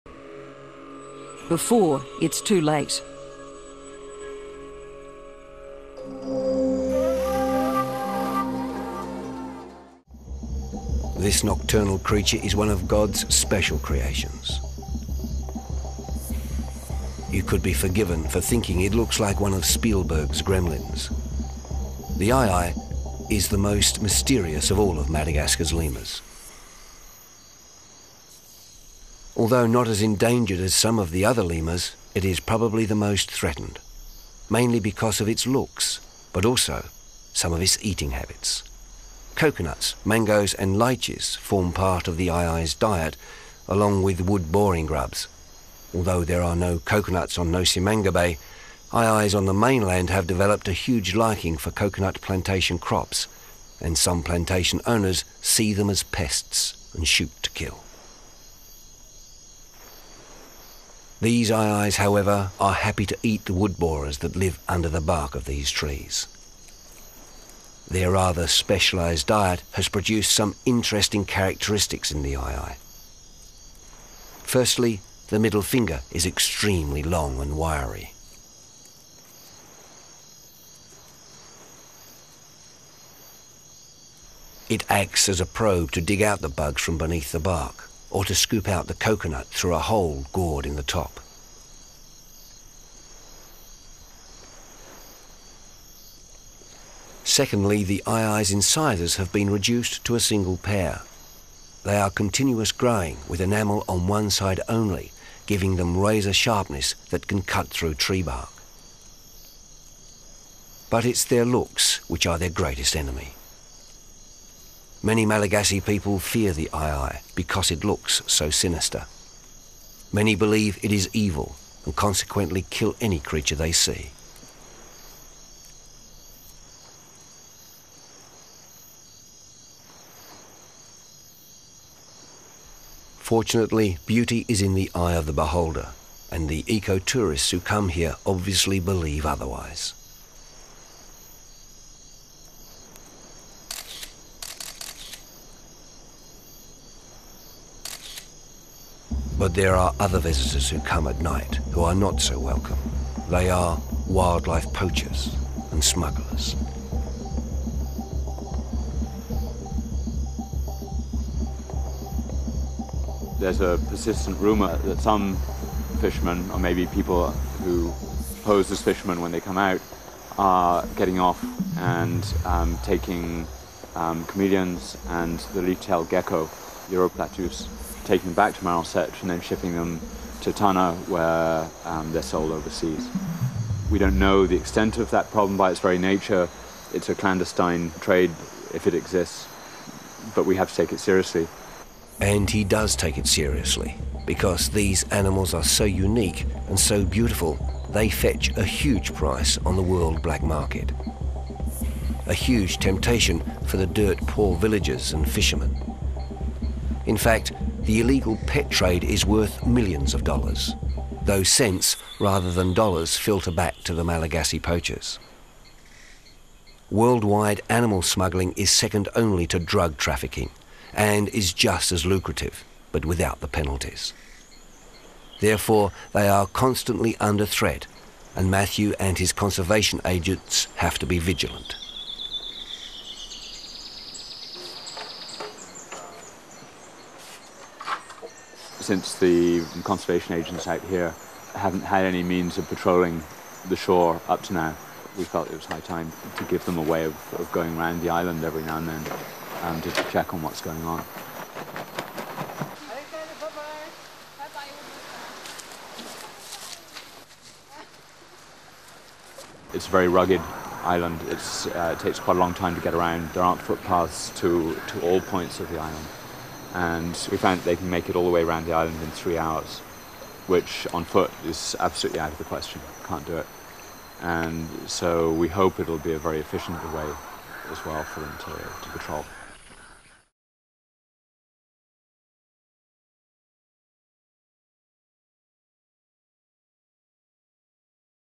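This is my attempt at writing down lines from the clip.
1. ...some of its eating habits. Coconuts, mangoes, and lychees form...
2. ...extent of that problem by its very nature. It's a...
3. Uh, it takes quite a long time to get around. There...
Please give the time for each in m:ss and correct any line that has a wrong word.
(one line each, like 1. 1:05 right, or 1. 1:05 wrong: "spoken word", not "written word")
1. 0:37 right
2. 3:04 right
3. 4:21 right.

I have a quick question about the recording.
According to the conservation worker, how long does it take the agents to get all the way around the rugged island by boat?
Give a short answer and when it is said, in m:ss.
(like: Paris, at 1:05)
3 hours, at 4:29.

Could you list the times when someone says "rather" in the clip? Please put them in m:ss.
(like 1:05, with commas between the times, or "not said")
1:08, 3:32.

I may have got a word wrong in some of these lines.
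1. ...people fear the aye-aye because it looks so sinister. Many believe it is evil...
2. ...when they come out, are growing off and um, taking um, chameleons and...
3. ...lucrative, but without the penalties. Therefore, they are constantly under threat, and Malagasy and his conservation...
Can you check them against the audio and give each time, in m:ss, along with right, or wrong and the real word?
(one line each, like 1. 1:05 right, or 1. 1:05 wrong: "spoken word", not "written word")
1. 1:55 right
2. 2:49 wrong: "getting", not "growing"
3. 3:42 wrong: "Matthew", not "Malagasy".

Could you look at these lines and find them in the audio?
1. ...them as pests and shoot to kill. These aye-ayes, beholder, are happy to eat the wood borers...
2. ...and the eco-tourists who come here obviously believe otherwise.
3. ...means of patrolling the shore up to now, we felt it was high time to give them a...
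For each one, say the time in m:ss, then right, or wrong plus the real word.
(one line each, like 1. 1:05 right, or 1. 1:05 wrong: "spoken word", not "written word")
1. 0:55 wrong: "however", not "beholder"
2. 2:16 right
3. 4:02 right.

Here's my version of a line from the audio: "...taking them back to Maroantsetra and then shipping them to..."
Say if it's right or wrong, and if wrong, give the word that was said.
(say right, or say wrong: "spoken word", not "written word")
right.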